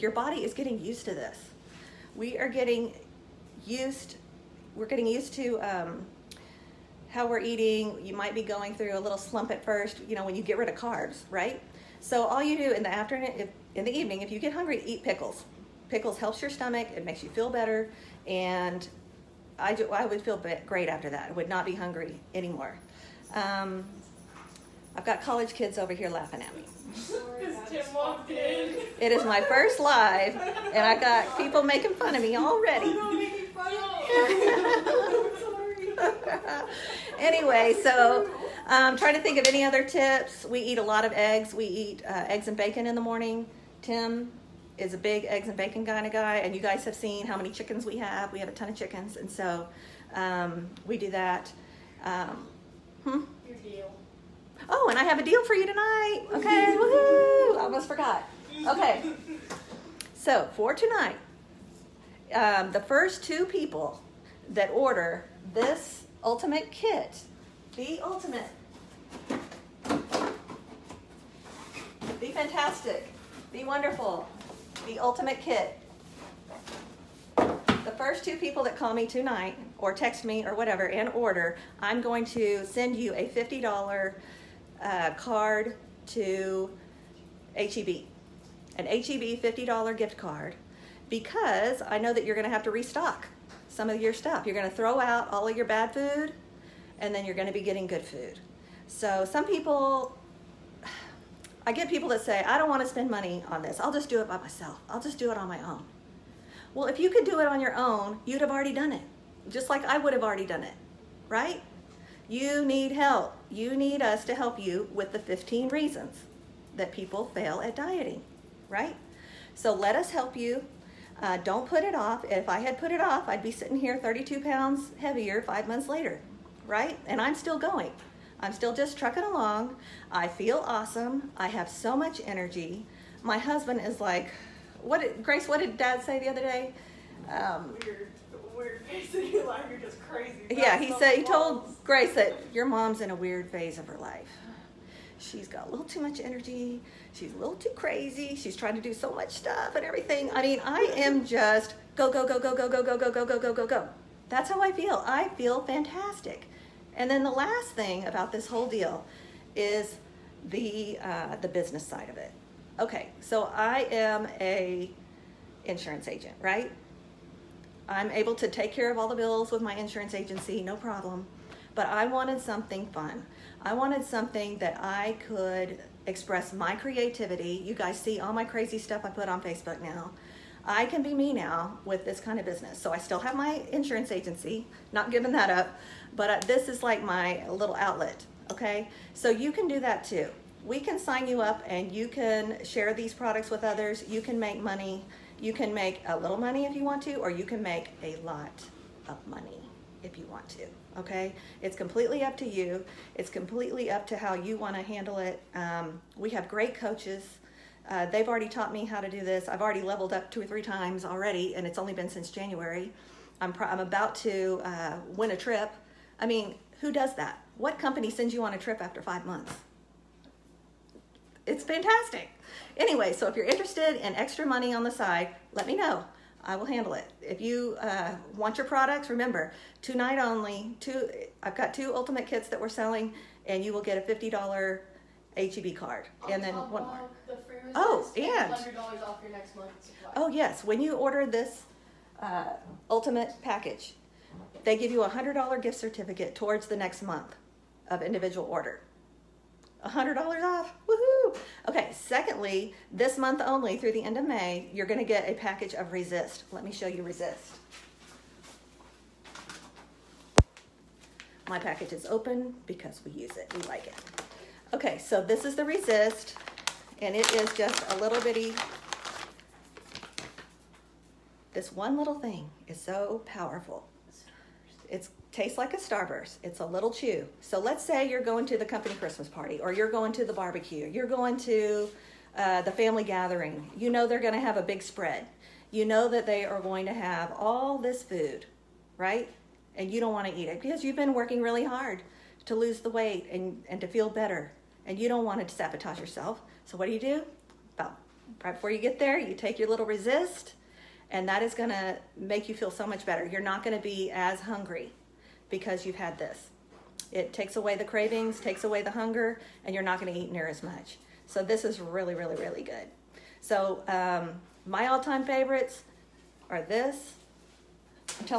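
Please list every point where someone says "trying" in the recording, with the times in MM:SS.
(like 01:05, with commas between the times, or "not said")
00:38, 02:28.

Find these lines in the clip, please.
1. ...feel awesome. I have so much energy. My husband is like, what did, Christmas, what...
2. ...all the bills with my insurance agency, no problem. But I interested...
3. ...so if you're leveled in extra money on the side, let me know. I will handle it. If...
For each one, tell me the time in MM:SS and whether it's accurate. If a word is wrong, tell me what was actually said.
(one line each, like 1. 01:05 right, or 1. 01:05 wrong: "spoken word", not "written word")
1. 02:10 wrong: "Grace", not "Christmas"
2. 02:48 wrong: "wanted", not "interested"
3. 03:43 wrong: "interested", not "leveled".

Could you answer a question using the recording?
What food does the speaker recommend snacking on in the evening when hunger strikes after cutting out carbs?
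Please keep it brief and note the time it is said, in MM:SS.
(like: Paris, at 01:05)
Pickles, at 00:14.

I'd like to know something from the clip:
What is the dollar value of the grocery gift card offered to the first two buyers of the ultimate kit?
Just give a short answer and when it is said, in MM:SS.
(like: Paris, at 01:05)
$50, at 01:23.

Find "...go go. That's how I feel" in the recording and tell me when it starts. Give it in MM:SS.
02:33.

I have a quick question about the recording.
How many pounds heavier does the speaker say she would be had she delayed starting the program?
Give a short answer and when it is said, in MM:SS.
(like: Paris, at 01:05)
32, at 02:03.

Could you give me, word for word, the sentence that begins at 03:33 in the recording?
I'm, I'm about to uh, win a trip.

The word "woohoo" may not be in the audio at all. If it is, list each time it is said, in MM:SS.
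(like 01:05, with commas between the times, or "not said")
00:56, 04:10.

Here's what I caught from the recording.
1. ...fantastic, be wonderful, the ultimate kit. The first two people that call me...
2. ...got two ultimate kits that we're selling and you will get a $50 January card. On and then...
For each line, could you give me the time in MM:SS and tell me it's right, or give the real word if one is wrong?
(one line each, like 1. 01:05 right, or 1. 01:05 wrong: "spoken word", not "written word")
1. 01:12 right
2. 03:51 wrong: "HEB", not "January".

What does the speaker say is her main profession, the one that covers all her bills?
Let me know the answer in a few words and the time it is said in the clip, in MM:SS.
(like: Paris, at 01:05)
Insurance agent, at 02:45.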